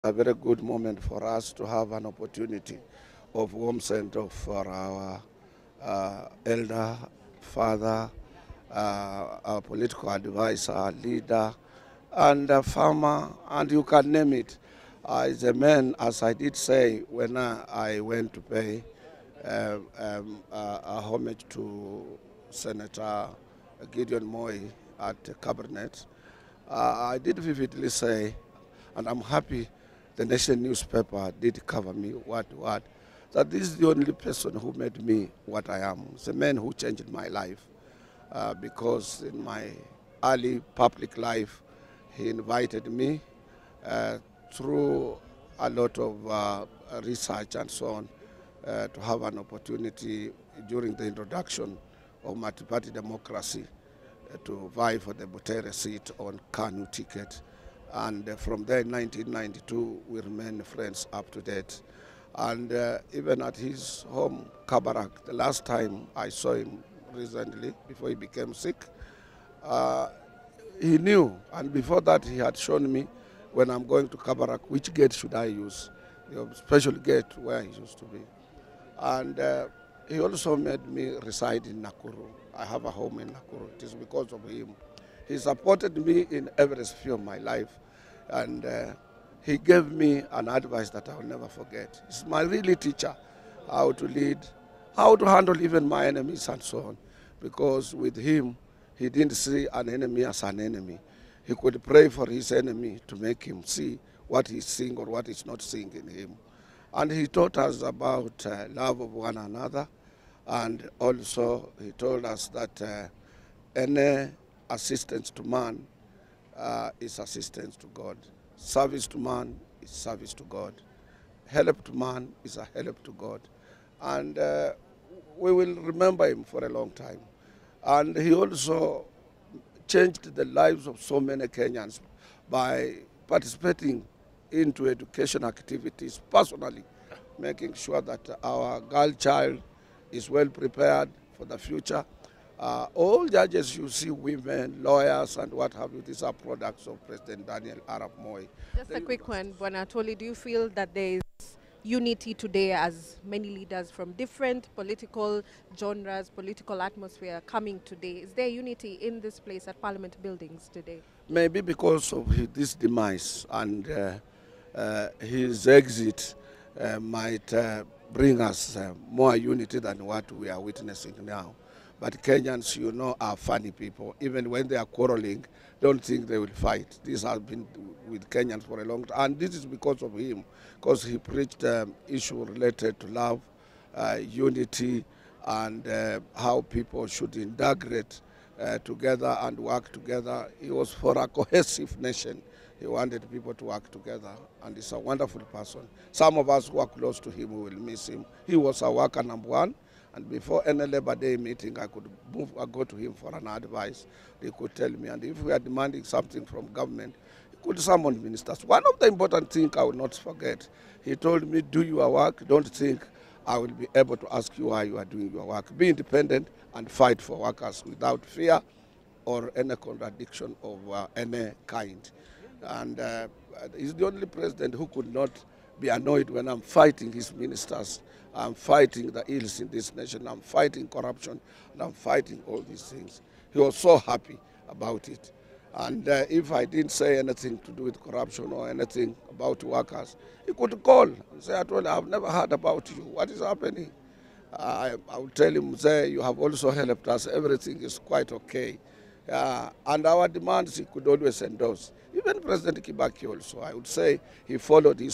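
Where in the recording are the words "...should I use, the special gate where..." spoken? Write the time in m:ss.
1:15.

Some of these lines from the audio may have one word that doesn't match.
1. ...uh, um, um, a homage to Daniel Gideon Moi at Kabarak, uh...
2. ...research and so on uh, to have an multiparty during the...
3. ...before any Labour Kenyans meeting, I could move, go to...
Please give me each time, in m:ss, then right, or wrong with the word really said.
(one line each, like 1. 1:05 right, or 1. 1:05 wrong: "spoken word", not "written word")
1. 0:19 wrong: "Senator", not "Daniel"
2. 0:47 wrong: "opportunity", not "multiparty"
3. 3:20 wrong: "Day", not "Kenyans".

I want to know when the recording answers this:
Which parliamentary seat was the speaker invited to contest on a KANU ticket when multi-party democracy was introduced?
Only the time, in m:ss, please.
0:55.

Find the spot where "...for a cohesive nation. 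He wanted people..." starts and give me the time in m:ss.
3:10.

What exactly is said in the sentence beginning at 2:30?
Do you feel that there is unity today as many leaders from different political genres, political atmosphere coming today?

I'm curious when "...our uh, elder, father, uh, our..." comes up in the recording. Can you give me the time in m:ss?
0:04.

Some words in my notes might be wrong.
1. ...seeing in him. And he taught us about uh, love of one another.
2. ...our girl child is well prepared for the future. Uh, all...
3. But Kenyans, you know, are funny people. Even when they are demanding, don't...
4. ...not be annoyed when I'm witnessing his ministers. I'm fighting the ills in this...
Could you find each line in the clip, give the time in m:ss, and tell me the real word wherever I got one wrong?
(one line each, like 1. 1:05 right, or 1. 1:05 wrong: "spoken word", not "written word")
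1. 1:45 right
2. 2:18 right
3. 2:52 wrong: "quarreling", not "demanding"
4. 3:45 wrong: "fighting", not "witnessing".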